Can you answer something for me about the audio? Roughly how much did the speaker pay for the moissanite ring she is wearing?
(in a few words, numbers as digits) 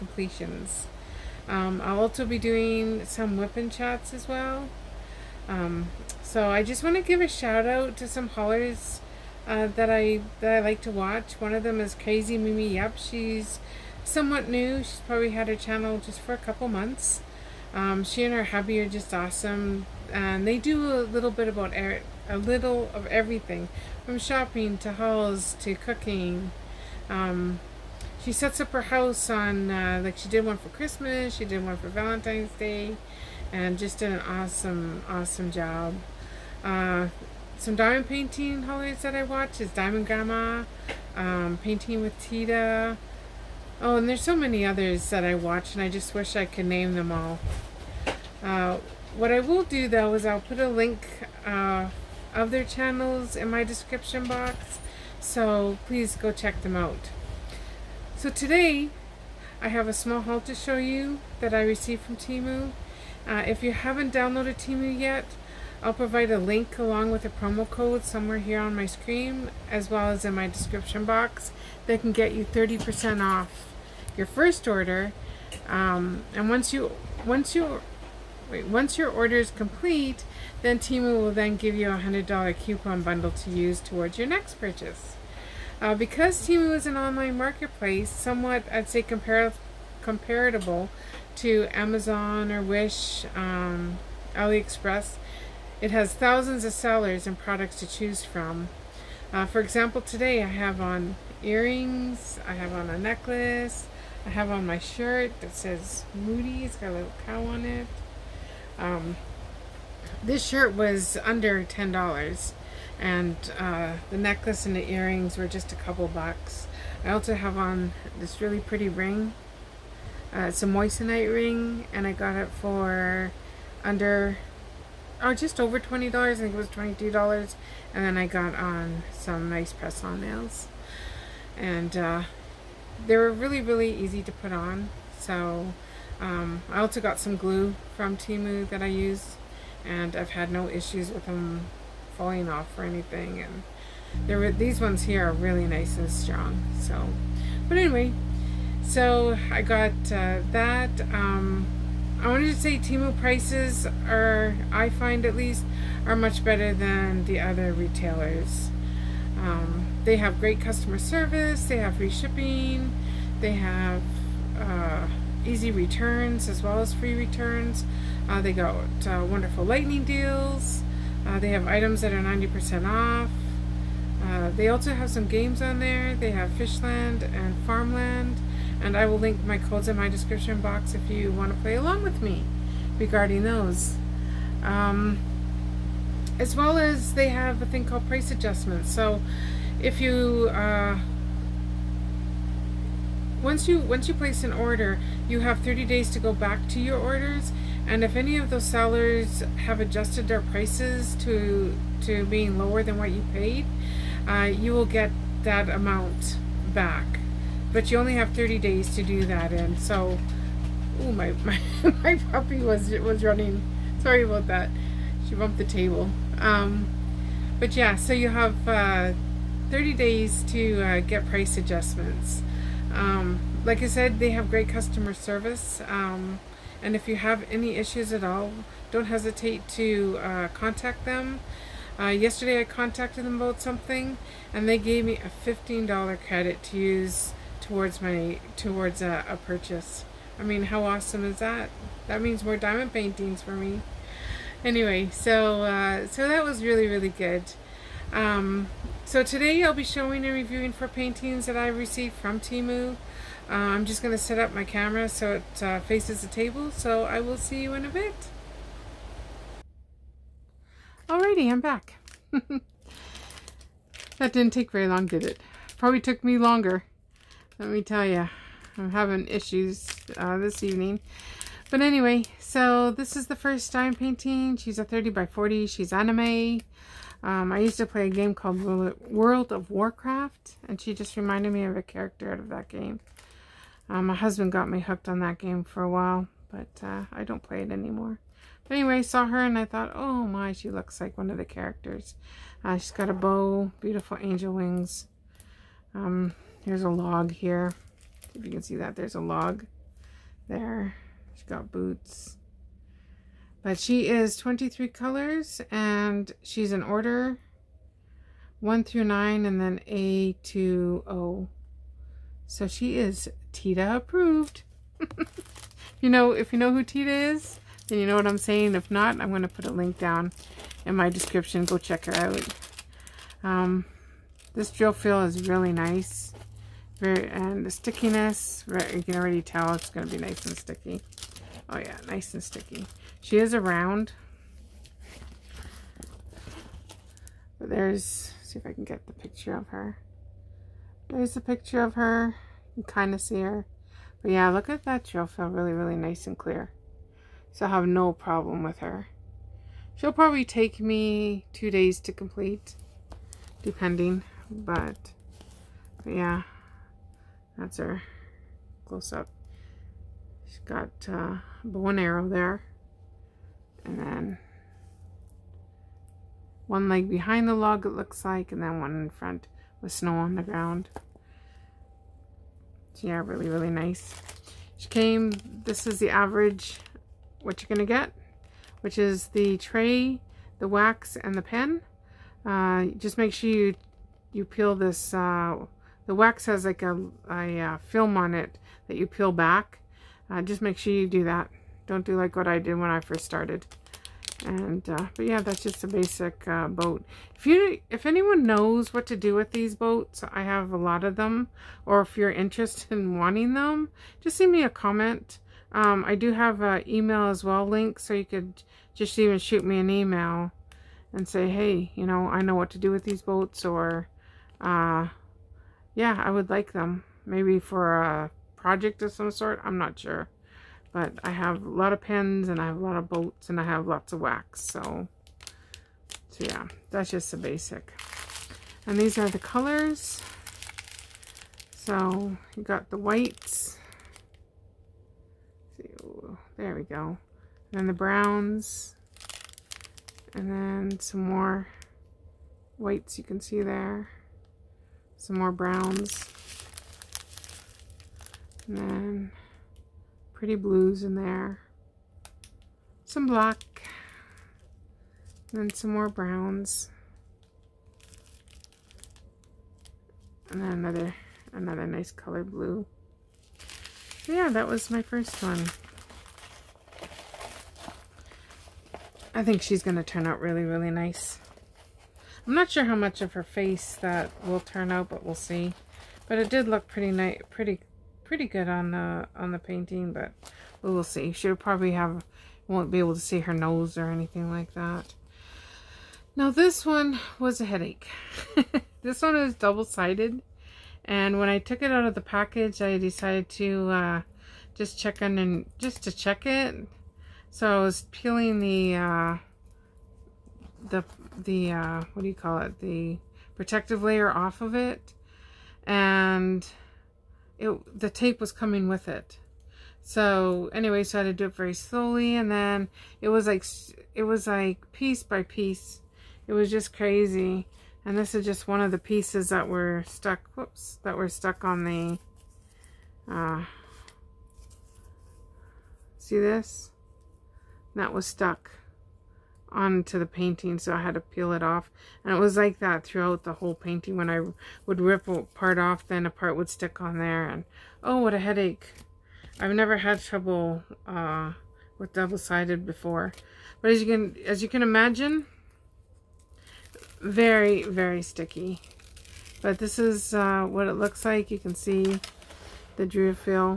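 $22.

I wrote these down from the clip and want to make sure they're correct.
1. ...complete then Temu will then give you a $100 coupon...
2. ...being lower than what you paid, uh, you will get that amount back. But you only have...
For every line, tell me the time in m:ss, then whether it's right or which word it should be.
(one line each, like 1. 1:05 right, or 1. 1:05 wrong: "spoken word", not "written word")
1. 1:19 right
2. 3:22 right.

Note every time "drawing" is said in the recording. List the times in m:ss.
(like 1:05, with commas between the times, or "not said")
not said.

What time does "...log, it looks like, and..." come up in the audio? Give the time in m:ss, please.
6:07.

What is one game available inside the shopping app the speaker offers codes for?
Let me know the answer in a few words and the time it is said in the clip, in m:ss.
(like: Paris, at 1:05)
Fishland, at 2:56.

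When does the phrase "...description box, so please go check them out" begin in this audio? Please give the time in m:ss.
0:53.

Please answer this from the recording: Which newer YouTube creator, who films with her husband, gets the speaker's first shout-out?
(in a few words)
Crazy Mimi.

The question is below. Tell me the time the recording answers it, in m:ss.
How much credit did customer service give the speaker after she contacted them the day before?
3:55.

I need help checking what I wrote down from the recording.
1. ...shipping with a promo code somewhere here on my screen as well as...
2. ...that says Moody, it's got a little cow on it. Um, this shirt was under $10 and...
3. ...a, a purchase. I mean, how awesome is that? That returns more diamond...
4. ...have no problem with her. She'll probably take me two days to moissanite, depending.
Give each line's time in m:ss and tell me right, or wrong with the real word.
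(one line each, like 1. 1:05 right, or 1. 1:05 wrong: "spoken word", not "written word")
1. 1:06 wrong: "along", not "shipping"
2. 1:45 right
3. 3:59 wrong: "means", not "returns"
4. 5:47 wrong: "complete", not "moissanite".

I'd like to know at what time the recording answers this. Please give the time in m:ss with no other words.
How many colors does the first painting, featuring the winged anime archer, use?
5:04.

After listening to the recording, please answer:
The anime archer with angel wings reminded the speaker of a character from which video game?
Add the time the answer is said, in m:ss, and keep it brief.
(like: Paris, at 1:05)
World of Warcraft, at 4:39.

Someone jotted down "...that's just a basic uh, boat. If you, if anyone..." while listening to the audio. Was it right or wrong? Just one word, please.
right.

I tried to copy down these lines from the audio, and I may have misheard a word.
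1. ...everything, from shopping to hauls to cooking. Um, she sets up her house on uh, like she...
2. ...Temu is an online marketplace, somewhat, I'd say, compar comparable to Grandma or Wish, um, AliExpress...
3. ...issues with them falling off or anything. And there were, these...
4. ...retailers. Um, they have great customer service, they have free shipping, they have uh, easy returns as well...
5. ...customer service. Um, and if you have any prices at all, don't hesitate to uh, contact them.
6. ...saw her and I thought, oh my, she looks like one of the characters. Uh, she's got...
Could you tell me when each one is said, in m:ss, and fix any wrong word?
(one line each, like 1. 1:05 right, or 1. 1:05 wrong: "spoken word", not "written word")
1. 0:23 right
2. 1:26 wrong: "Amazon", not "Grandma"
3. 2:20 right
4. 2:37 right
5. 3:44 wrong: "issues", not "prices"
6. 4:49 right.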